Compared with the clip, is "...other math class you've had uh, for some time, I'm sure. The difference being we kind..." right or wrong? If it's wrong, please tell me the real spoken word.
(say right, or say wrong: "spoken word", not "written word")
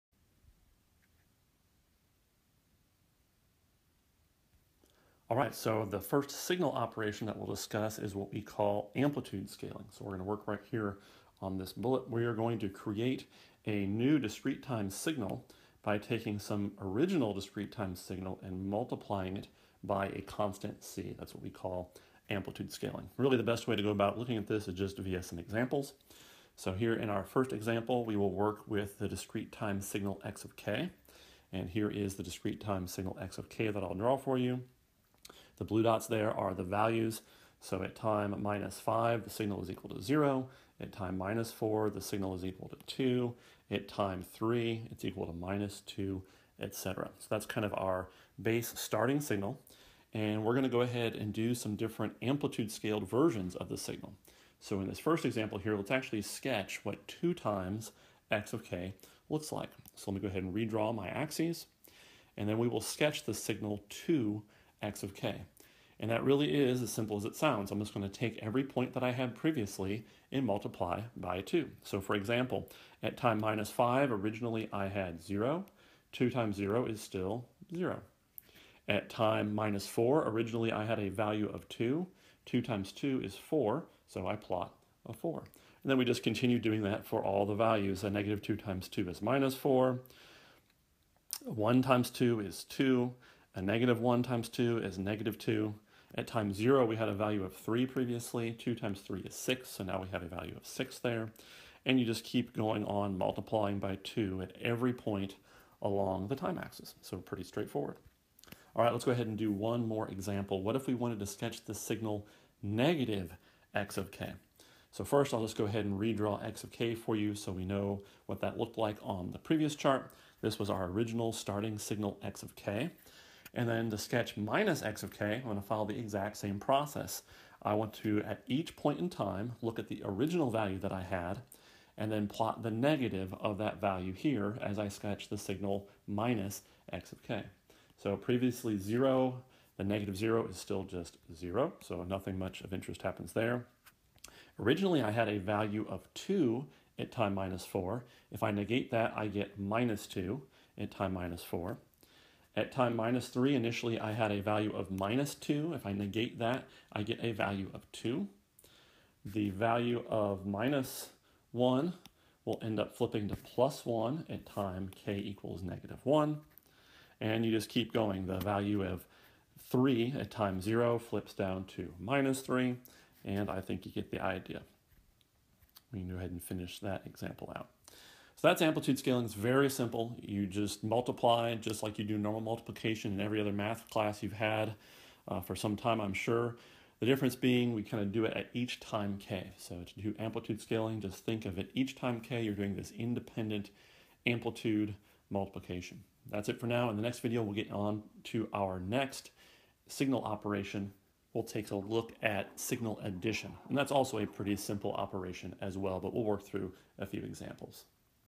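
right.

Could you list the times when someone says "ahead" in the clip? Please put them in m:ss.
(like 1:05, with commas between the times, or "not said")
0:50, 1:00, 1:49, 1:55, 2:56.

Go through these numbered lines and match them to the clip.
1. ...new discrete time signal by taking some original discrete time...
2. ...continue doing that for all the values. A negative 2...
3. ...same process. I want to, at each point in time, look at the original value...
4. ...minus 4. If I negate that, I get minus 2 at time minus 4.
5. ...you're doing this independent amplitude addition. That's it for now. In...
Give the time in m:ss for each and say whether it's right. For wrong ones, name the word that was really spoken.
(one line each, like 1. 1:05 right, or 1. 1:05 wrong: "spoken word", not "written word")
1. 0:13 right
2. 1:26 right
3. 2:06 right
4. 2:27 right
5. 3:12 wrong: "multiplication", not "addition".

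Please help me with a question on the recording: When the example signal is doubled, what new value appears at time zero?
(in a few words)
6.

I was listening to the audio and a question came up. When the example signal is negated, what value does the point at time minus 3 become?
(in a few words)
2.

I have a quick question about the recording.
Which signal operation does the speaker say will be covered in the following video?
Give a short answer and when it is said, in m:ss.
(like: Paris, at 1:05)
Signal addition, at 3:22.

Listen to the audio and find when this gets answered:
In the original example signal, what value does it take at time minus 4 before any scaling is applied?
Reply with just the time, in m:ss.
0:40.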